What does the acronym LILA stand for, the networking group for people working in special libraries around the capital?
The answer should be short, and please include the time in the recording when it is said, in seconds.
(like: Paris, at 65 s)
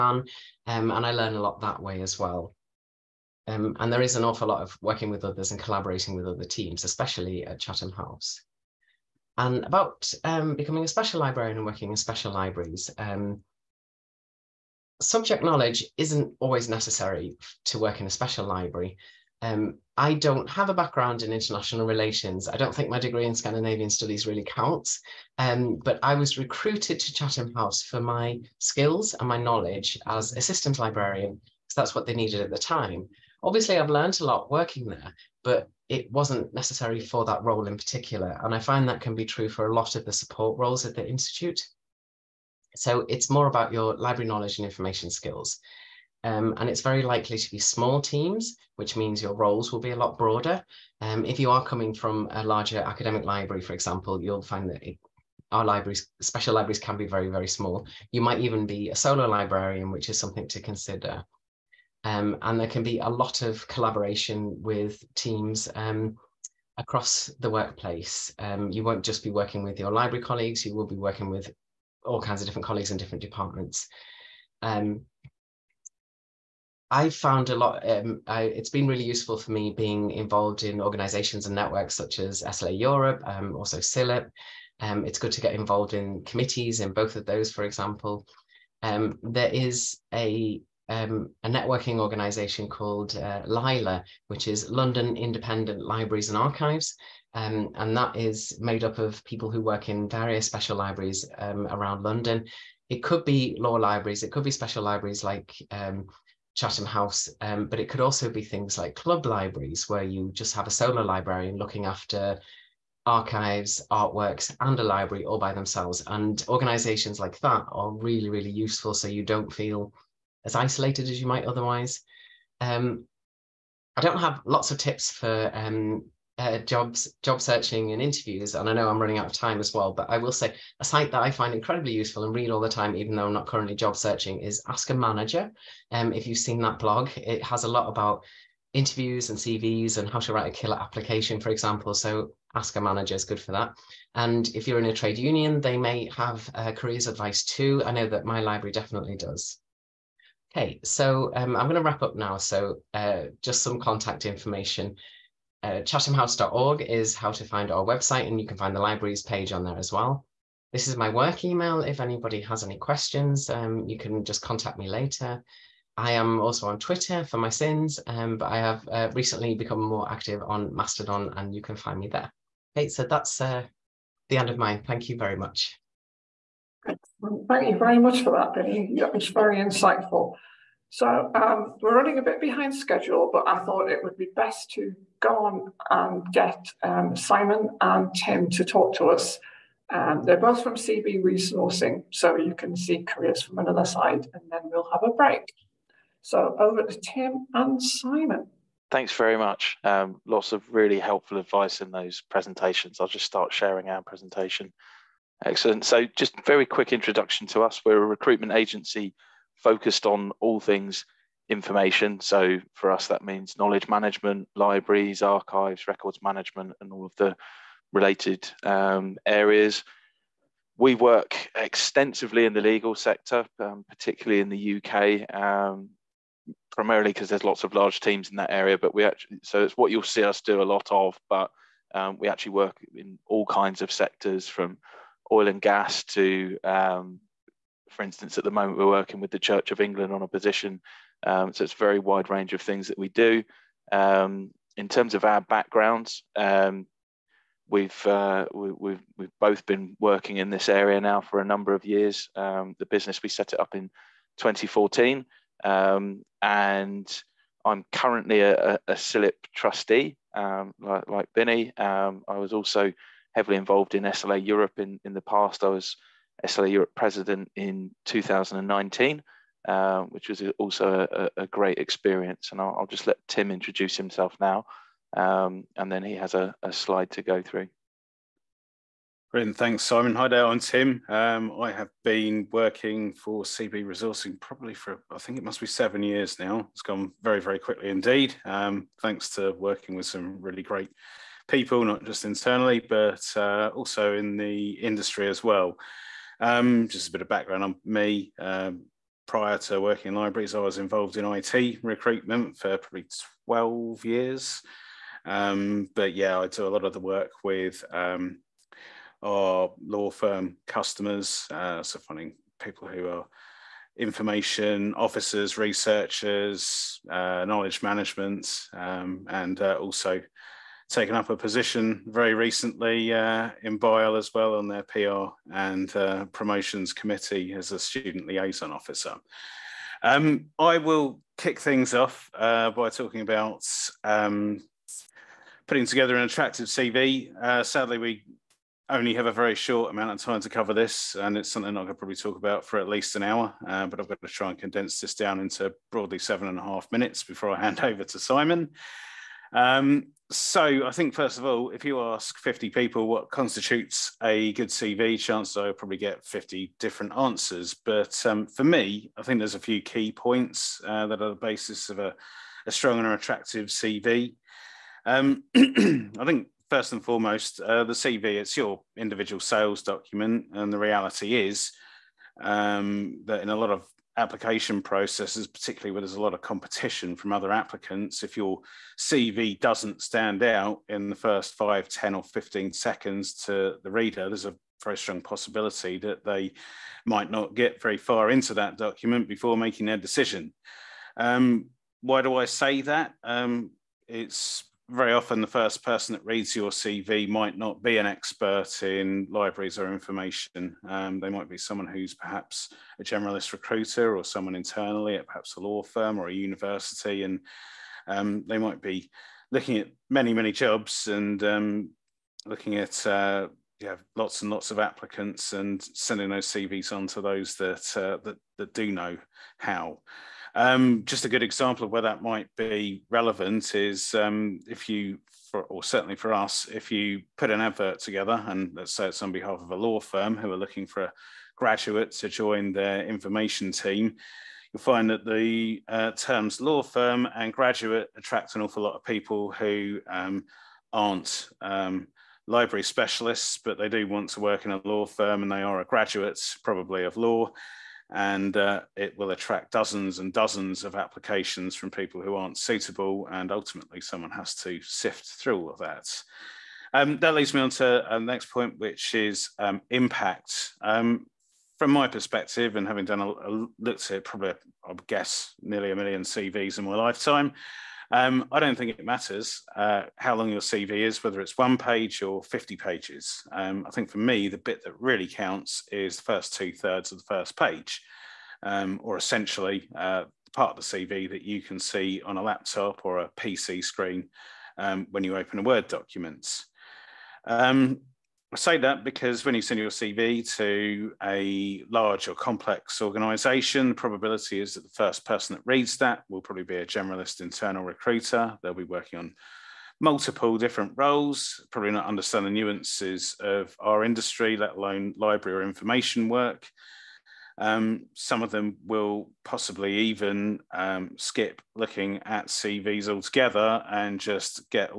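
London Independent Libraries and Archives, at 94 s.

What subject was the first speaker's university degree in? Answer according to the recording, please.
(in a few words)
Scandinavian studies.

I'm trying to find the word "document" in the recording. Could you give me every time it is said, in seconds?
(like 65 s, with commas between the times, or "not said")
369 s, 388 s, 485 s.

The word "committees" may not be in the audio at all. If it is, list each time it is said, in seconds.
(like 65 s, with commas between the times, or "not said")
86 s, 326 s.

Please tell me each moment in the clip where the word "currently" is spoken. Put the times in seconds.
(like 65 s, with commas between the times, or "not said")
133 s, 257 s.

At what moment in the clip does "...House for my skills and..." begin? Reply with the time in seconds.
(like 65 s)
27 s.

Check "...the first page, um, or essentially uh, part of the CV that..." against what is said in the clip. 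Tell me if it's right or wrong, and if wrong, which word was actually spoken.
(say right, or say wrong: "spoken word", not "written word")
right.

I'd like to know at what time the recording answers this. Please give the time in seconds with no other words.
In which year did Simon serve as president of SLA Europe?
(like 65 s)
268 s.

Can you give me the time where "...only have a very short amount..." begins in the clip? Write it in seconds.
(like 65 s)
338 s.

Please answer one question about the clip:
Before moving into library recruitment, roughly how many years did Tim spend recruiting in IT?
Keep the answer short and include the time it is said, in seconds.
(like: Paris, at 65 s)
12 years, at 303 s.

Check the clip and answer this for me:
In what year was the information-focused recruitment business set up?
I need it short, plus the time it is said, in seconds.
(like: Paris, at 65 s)
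2014, at 254 s.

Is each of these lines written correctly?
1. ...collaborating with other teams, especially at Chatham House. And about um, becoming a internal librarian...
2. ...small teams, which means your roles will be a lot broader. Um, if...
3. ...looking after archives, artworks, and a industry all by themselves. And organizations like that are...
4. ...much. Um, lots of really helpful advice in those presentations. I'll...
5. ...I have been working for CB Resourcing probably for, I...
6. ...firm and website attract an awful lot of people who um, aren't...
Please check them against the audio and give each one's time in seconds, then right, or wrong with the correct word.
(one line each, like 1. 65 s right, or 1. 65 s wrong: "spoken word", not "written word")
1. 5 s wrong: "special", not "internal"
2. 47 s right
3. 111 s wrong: "library", not "industry"
4. 199 s right
5. 281 s right
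6. 436 s wrong: "graduate", not "website".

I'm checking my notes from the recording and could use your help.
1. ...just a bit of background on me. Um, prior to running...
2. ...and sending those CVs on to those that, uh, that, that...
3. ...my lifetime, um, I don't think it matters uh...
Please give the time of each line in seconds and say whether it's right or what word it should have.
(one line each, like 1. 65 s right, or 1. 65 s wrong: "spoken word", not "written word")
1. 296 s wrong: "working", not "running"
2. 415 s right
3. 466 s right.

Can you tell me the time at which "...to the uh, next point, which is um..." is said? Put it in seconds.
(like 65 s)
457 s.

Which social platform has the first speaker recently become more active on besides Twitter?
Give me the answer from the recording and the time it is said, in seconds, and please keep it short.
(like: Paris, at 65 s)
Mastodon, at 170 s.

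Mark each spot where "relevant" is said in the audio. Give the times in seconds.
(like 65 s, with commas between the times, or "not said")
423 s.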